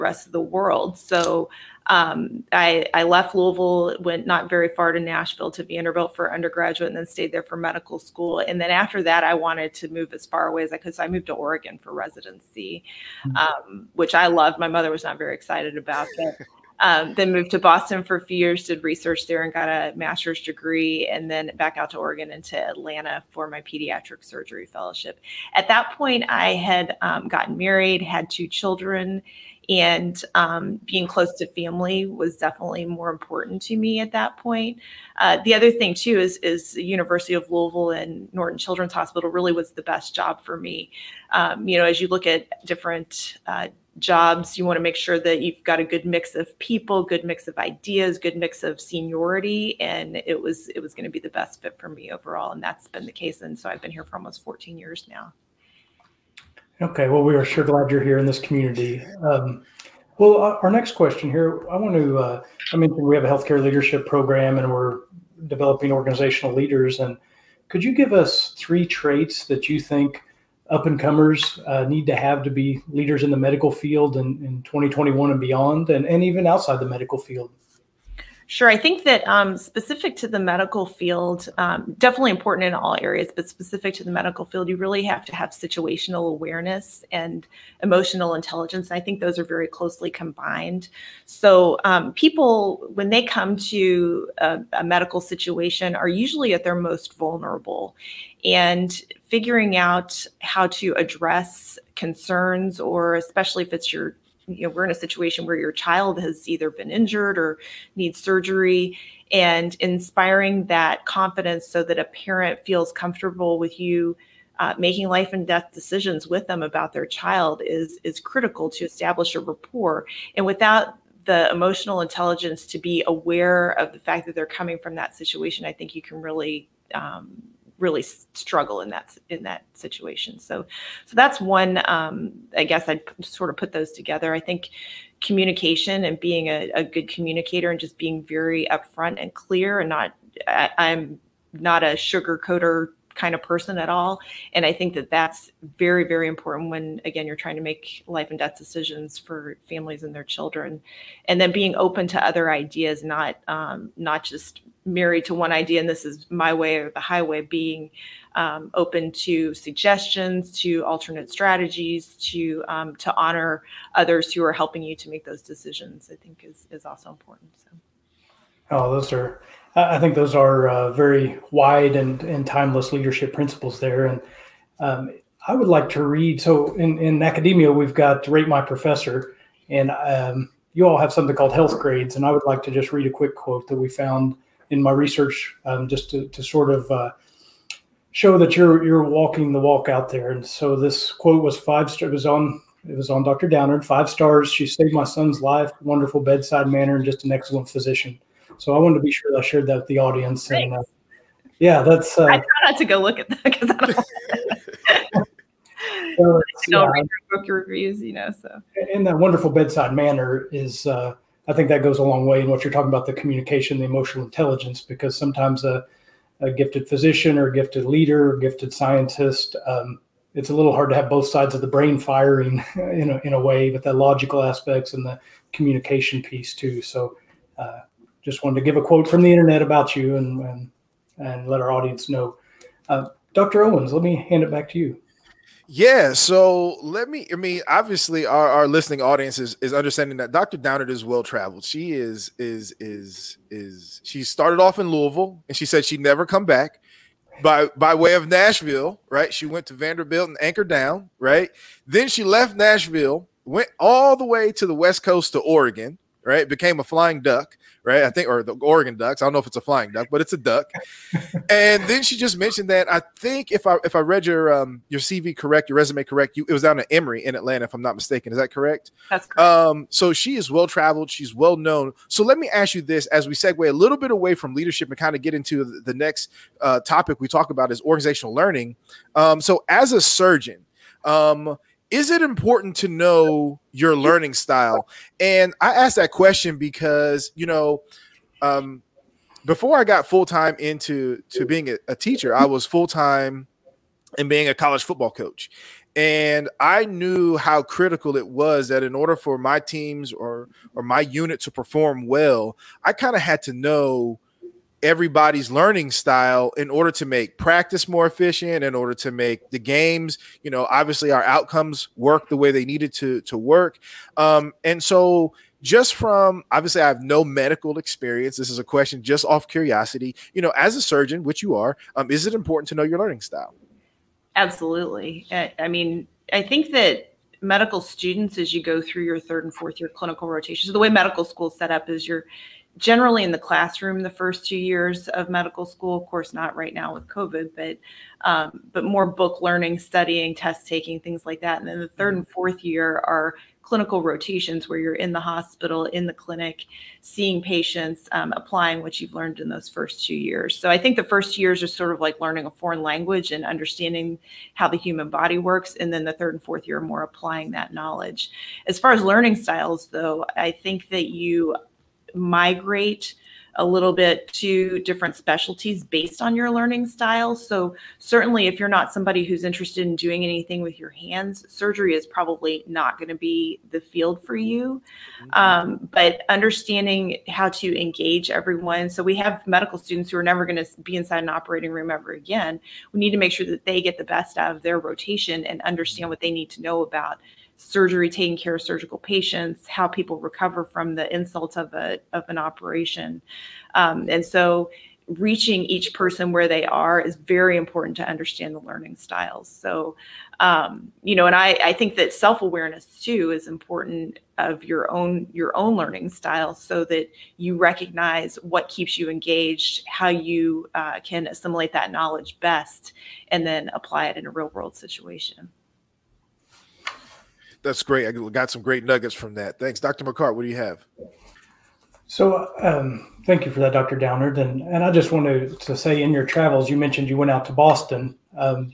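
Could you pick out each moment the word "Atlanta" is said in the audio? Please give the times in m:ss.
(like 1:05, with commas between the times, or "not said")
0:22, 4:27.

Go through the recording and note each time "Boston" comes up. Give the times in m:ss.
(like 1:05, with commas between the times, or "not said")
0:17, 7:07.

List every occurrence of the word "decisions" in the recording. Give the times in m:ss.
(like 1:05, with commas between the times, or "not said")
1:55, 2:28, 2:45.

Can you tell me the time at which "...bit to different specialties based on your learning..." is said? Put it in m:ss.
6:03.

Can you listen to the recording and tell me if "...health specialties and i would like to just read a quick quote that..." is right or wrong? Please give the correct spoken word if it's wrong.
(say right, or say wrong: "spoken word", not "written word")
wrong: "grades", not "specialties".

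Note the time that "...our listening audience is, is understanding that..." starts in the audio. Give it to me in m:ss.
3:58.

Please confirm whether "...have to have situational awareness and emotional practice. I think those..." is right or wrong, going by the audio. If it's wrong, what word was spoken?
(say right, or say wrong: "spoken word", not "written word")
wrong: "intelligence", not "practice".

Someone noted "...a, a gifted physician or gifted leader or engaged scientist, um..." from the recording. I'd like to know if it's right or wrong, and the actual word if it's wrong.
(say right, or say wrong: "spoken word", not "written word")
wrong: "gifted", not "engaged".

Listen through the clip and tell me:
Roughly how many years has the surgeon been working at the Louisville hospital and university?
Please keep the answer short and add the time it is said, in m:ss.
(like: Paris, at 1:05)
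14, at 0:54.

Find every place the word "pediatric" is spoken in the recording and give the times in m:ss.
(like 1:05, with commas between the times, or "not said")
0:23.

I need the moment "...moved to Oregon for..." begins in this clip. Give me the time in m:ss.
0:11.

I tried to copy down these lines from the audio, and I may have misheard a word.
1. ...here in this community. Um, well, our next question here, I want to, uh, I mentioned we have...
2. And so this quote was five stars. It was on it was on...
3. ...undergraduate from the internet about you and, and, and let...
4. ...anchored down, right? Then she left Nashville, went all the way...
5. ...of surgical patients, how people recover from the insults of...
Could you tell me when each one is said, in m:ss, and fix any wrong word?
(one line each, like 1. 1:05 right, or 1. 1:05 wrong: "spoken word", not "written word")
1. 0:58 right
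2. 3:10 right
3. 3:48 wrong: "quote", not "undergraduate"
4. 4:10 right
5. 6:28 right.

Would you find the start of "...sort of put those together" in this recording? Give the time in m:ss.
2:13.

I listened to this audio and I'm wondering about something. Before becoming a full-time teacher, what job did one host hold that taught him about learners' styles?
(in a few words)
College football coach.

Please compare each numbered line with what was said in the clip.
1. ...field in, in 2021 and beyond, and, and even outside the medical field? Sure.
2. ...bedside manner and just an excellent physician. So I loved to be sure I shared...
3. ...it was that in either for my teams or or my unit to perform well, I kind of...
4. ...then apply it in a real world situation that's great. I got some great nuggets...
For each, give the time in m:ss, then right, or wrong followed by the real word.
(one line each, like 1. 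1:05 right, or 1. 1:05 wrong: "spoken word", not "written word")
1. 1:13 right
2. 3:16 wrong: "wanted", not "loved"
3. 4:58 wrong: "order", not "either"
4. 6:53 right.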